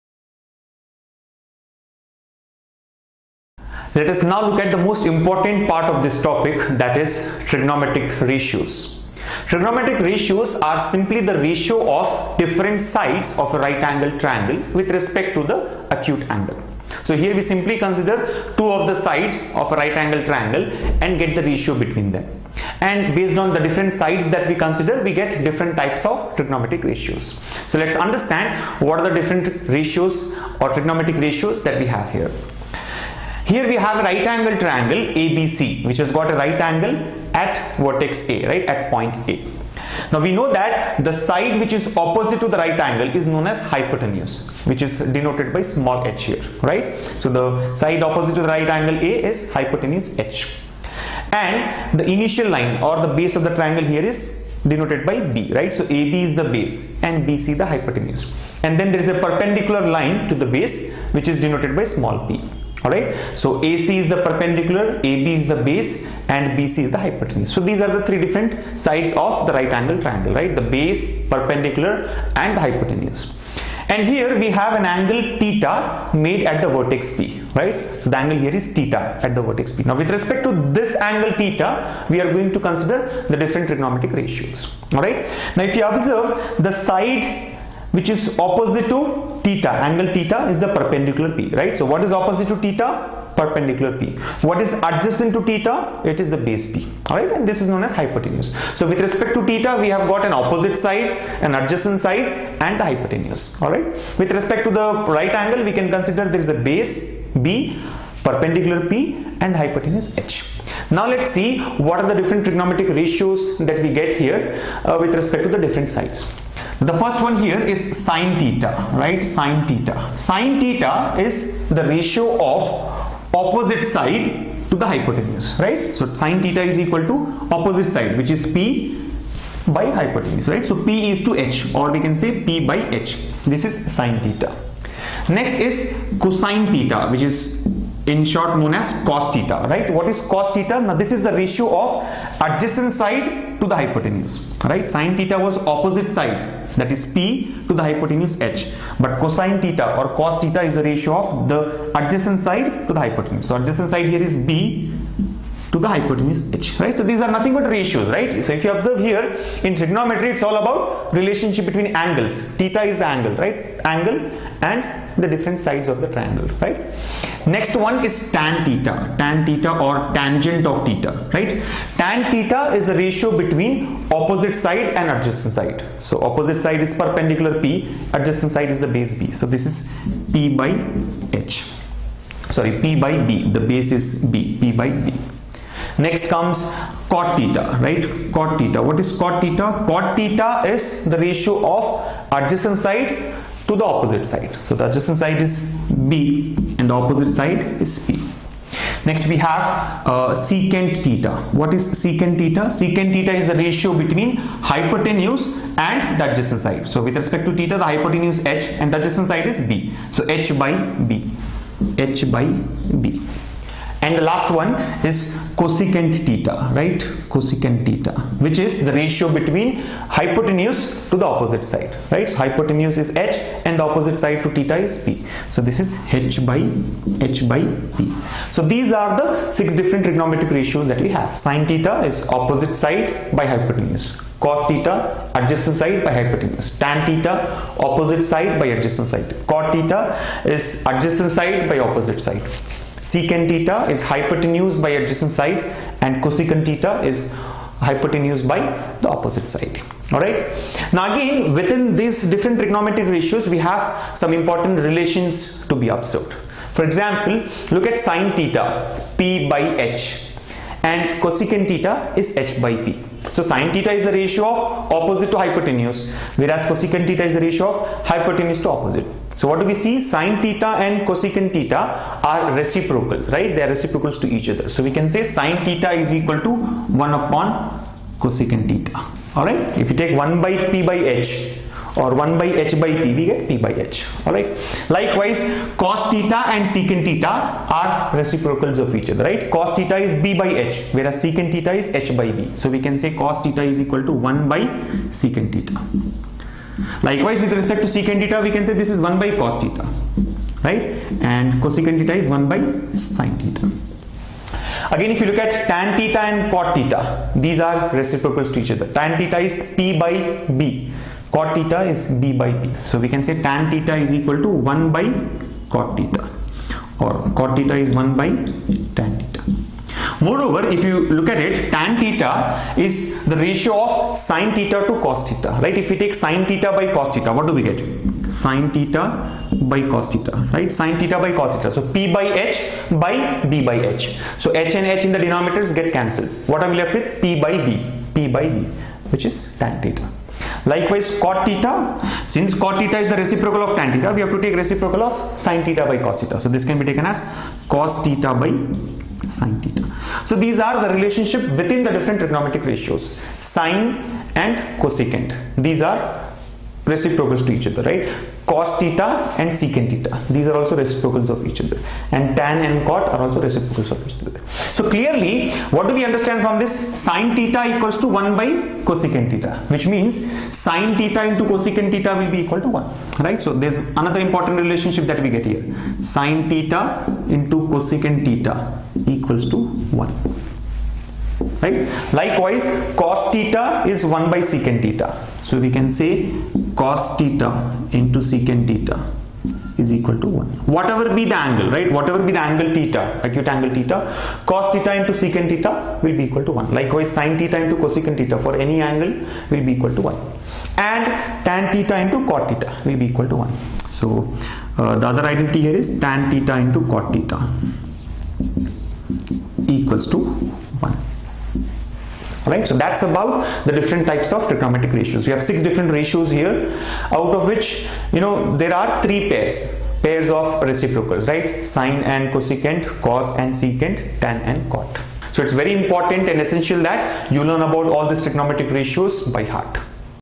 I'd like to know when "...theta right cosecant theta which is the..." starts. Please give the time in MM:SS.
03:36.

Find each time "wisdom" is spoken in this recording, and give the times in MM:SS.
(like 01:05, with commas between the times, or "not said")
not said.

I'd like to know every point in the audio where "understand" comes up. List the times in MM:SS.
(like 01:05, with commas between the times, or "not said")
00:27, 06:06.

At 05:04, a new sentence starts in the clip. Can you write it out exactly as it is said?
Again if you look at tan theta and cot theta these are reciprocals to each other.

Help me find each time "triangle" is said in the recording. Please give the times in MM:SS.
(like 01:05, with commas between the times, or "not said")
00:14, 00:20, 00:34, 00:53, 01:10, 02:46.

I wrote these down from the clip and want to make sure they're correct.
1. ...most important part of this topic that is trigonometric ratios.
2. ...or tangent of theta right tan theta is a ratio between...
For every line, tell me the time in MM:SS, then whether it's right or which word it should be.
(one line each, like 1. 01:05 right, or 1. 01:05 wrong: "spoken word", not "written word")
1. 00:04 right
2. 02:49 right.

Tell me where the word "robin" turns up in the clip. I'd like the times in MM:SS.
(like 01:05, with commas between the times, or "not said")
not said.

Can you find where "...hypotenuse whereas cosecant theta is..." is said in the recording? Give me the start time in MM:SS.
04:25.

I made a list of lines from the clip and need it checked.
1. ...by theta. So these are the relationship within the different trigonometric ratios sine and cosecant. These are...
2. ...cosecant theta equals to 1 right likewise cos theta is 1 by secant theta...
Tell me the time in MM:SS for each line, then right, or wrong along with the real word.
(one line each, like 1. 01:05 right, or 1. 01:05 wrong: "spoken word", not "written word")
1. 05:48 right
2. 06:17 right.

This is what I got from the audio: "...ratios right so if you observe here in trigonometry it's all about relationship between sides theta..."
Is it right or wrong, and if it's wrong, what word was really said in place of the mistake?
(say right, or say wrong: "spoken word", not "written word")
wrong: "angles", not "sides".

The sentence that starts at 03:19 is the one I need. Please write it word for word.
Next we have uh, secant theta.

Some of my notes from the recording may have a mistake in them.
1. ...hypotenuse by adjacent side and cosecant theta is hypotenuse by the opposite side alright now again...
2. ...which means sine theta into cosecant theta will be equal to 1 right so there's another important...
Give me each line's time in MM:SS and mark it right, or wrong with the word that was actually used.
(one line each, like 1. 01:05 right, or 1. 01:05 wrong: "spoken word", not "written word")
1. 04:04 right
2. 06:09 right.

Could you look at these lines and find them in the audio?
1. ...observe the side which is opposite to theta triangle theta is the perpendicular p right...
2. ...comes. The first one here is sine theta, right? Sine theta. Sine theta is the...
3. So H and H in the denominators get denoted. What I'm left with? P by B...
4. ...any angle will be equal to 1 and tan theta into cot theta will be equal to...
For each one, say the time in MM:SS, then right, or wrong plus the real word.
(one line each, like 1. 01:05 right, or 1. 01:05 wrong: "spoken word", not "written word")
1. 01:25 wrong: "angle", not "triangle"
2. 01:55 wrong: "sides", not "comes"
3. 05:34 wrong: "cancelled", not "denoted"
4. 06:38 right.